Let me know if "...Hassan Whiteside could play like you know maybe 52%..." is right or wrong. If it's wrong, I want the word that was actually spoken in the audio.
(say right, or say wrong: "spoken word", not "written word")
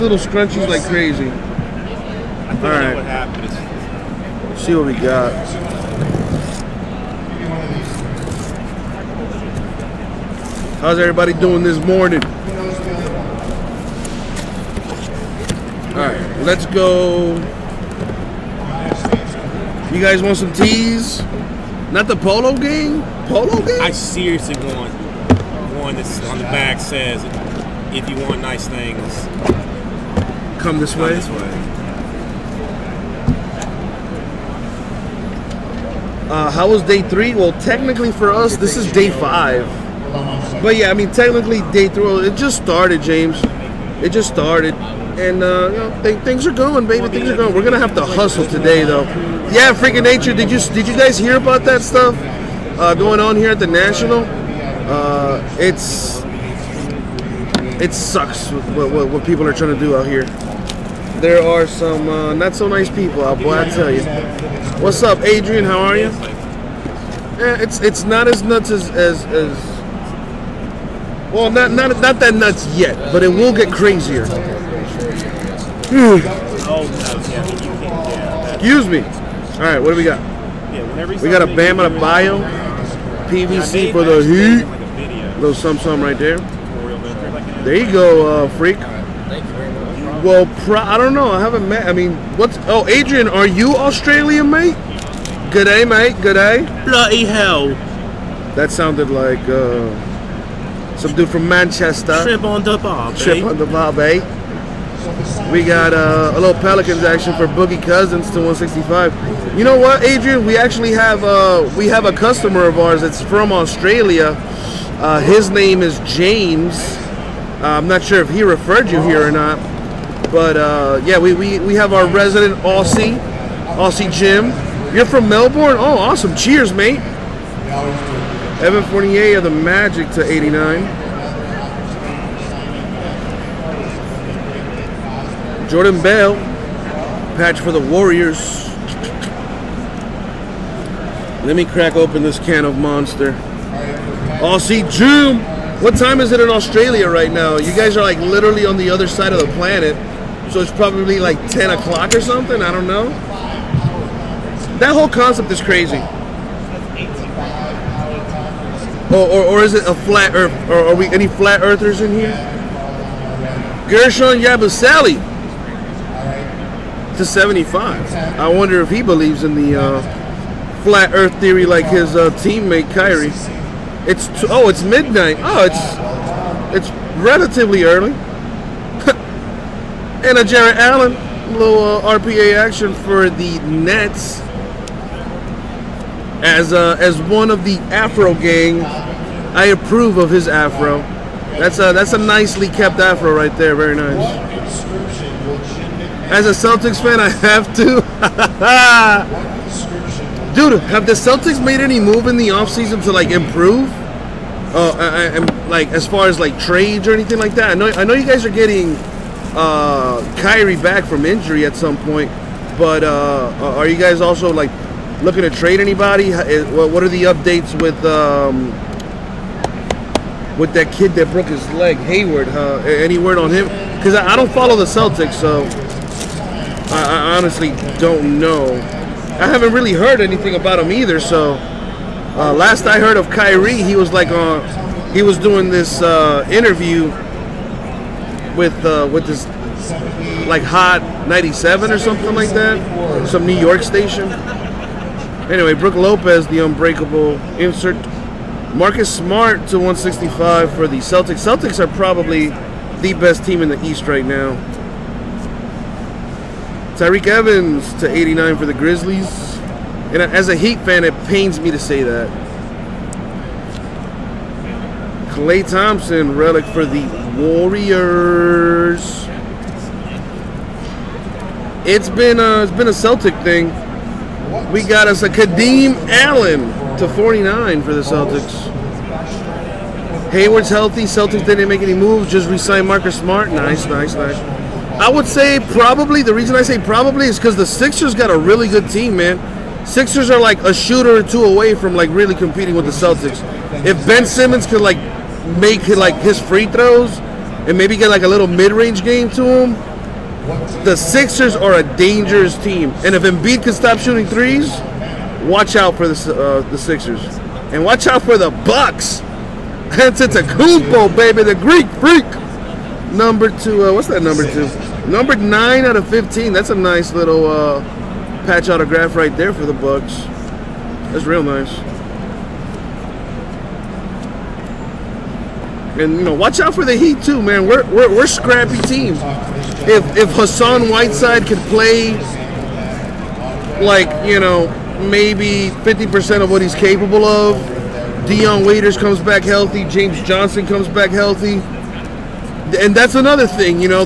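wrong: "50", not "52".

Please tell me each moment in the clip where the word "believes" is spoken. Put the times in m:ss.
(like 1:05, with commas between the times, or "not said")
2:49.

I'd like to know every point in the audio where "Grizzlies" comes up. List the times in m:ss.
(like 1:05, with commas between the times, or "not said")
4:18.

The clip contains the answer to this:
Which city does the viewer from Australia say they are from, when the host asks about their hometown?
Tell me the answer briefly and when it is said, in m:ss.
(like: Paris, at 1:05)
Melbourne, at 2:05.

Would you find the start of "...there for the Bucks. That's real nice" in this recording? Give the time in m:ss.
5:19.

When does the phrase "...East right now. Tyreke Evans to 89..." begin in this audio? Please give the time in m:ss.
4:13.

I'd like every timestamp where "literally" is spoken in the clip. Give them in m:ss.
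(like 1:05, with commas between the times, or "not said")
2:28.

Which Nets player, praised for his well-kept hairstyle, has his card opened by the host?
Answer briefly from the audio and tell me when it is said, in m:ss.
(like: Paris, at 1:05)
Jarrett Allen, at 3:00.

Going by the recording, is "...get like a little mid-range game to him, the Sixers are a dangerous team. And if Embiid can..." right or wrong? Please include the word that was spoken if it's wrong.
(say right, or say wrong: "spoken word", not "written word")
right.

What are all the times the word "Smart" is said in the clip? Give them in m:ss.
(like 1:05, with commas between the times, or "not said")
4:09, 4:43.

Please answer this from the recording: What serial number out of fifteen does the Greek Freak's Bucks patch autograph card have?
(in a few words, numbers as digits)
9.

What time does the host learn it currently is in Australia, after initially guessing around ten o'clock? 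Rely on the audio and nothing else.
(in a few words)
Midnight.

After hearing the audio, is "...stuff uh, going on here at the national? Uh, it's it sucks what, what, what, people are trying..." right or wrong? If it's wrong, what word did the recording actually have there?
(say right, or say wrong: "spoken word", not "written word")
right.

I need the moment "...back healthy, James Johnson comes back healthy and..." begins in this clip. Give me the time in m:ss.
5:39.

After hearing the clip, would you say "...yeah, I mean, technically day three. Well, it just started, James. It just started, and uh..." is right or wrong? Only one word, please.
right.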